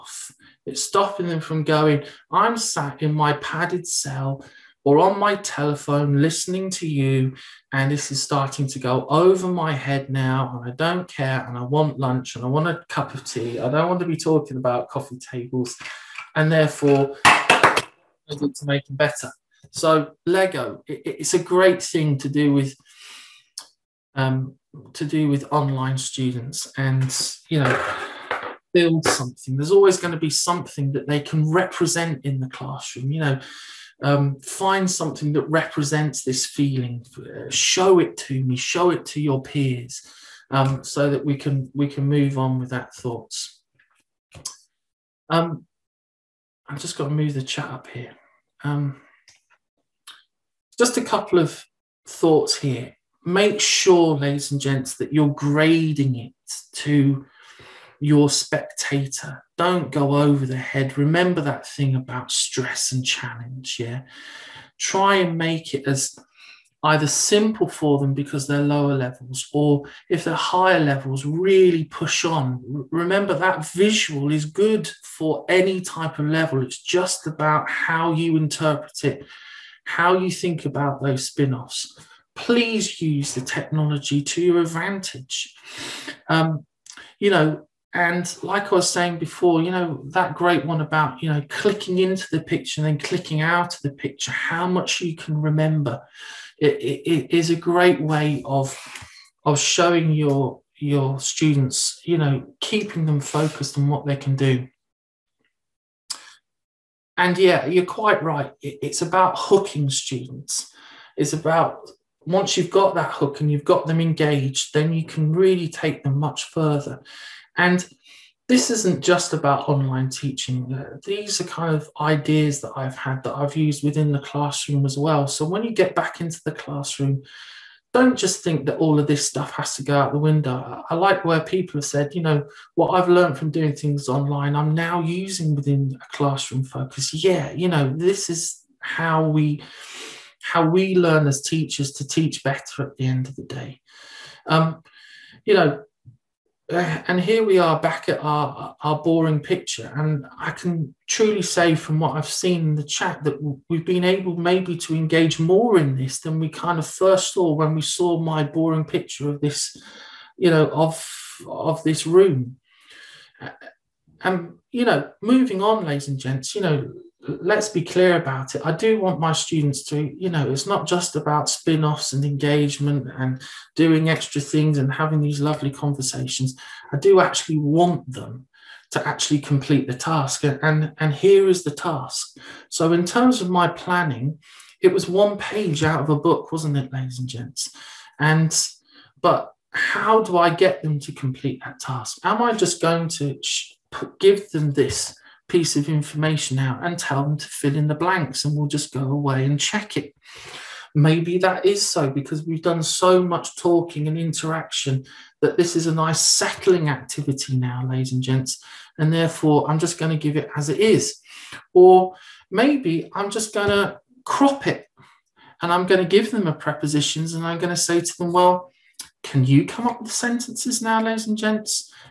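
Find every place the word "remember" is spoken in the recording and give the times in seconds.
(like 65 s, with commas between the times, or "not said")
60 s, 72 s, 95 s.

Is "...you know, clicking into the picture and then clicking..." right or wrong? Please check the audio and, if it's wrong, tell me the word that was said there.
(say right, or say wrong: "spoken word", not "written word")
right.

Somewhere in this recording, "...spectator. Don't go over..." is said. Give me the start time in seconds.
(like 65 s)
58 s.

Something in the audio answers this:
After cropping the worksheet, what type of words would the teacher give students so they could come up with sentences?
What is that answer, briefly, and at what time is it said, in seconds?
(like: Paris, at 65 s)
prepositions, at 216 s.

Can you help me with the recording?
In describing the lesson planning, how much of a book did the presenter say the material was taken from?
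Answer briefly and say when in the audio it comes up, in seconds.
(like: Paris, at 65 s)
one page, at 185 s.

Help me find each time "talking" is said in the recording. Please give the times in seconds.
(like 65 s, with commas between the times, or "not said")
14 s, 203 s.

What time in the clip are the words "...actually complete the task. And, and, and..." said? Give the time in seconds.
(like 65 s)
179 s.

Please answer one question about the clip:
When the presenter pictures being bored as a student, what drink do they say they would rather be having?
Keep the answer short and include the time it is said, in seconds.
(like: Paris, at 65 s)
a cup of tea, at 12 s.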